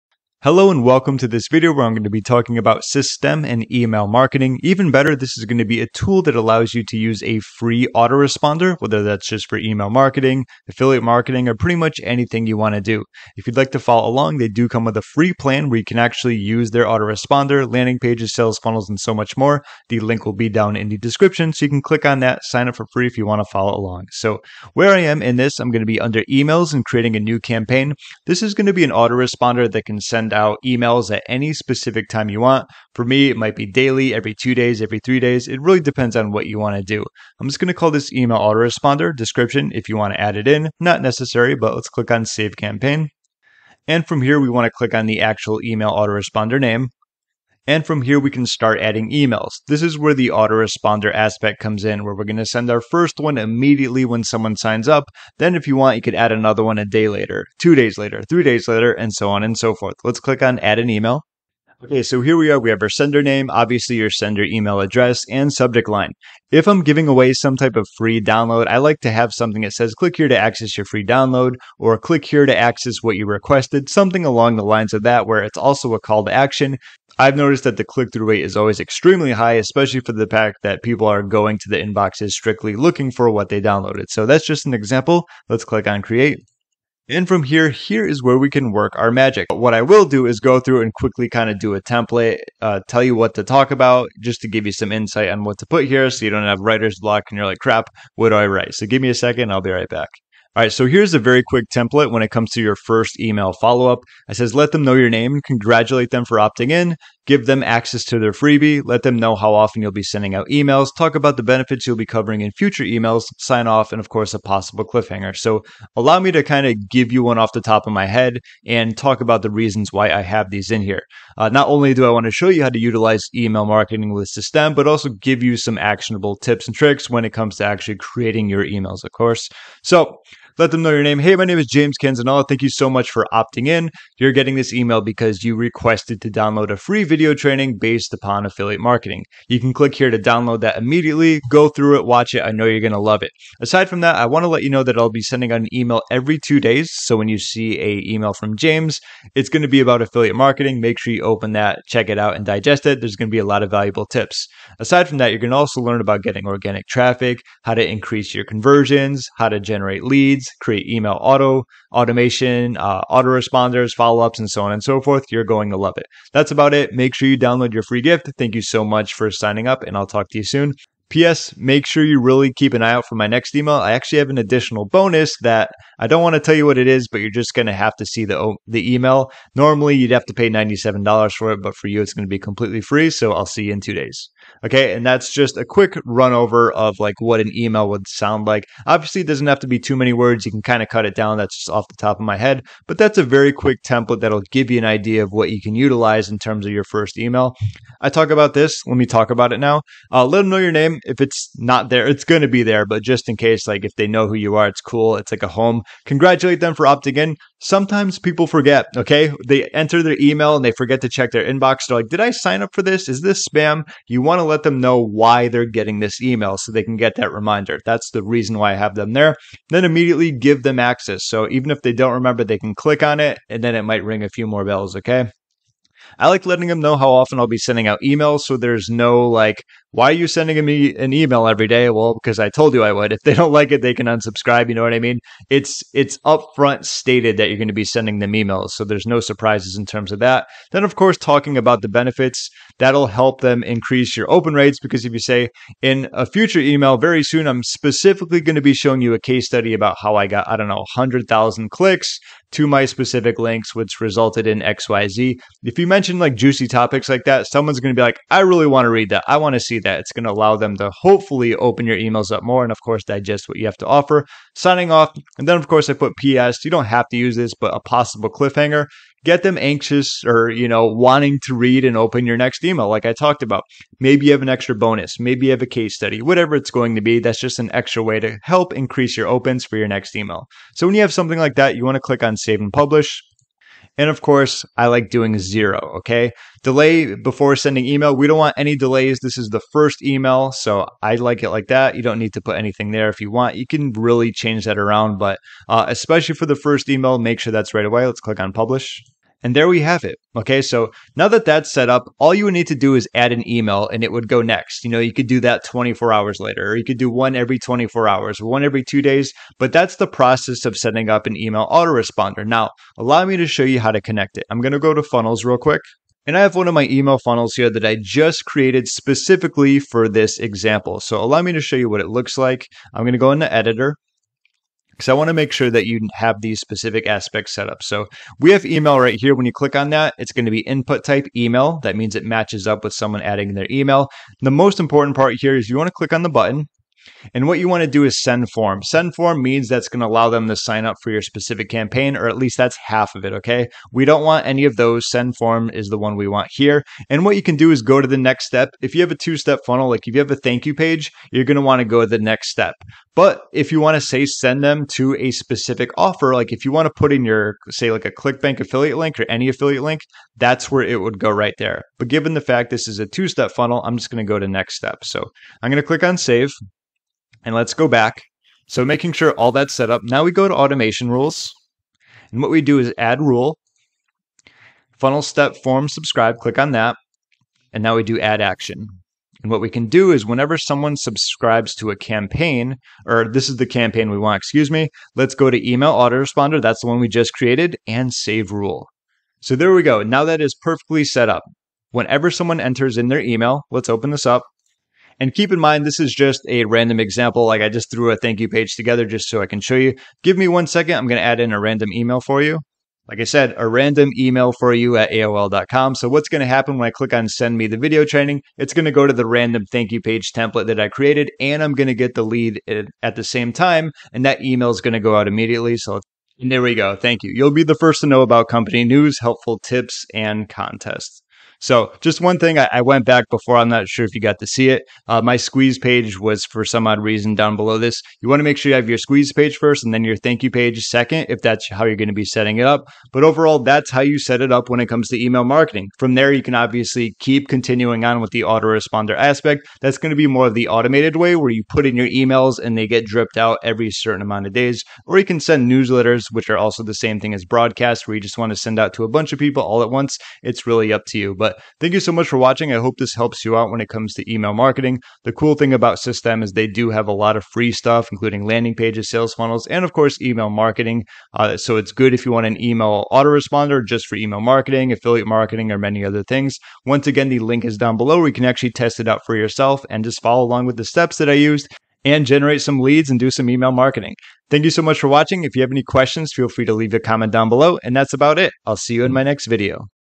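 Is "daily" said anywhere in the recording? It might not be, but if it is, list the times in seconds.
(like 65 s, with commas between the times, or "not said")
33 s.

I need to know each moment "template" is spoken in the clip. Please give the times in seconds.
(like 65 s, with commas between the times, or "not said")
91 s, 101 s, 193 s, 410 s.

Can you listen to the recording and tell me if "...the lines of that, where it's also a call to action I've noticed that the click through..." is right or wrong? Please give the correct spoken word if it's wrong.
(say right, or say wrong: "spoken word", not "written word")
right.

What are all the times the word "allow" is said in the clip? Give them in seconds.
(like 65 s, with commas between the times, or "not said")
6 s, 115 s, 260 s, 312 s, 321 s, 340 s.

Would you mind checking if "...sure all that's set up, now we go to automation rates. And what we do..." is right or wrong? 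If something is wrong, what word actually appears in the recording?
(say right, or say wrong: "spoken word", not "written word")
wrong: "rules", not "rates".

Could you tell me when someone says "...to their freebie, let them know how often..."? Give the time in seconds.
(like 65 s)
108 s.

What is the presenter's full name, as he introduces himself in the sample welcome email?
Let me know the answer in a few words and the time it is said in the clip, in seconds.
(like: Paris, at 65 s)
James Canzanella, at 131 s.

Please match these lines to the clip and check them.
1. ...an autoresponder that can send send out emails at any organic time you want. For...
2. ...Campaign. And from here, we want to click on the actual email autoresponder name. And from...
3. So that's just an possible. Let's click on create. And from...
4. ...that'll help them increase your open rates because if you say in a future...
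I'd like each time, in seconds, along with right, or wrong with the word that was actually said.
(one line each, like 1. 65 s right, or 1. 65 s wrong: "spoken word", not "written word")
1. 28 s wrong: "specific", not "organic"
2. 42 s right
3. 84 s wrong: "example", not "possible"
4. 242 s right.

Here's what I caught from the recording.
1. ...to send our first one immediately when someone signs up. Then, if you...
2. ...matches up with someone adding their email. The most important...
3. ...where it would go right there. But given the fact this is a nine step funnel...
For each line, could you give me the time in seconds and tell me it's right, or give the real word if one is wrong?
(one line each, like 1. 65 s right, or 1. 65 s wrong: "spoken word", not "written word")
1. 52 s right
2. 332 s right
3. 360 s wrong: "two", not "nine".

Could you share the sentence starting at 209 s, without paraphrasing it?
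They enter their email and they forget to check their inbox.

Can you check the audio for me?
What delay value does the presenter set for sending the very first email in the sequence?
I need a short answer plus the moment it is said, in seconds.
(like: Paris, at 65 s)
zero, at 285 s.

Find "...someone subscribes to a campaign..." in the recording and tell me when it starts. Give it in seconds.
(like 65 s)
380 s.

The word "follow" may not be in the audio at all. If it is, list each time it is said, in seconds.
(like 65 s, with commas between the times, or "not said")
13 s, 23 s, 103 s, 163 s, 470 s.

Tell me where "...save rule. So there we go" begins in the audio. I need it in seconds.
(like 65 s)
388 s.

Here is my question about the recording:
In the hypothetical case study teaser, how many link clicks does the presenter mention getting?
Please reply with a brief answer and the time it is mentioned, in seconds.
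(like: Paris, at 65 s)
100,000, at 250 s.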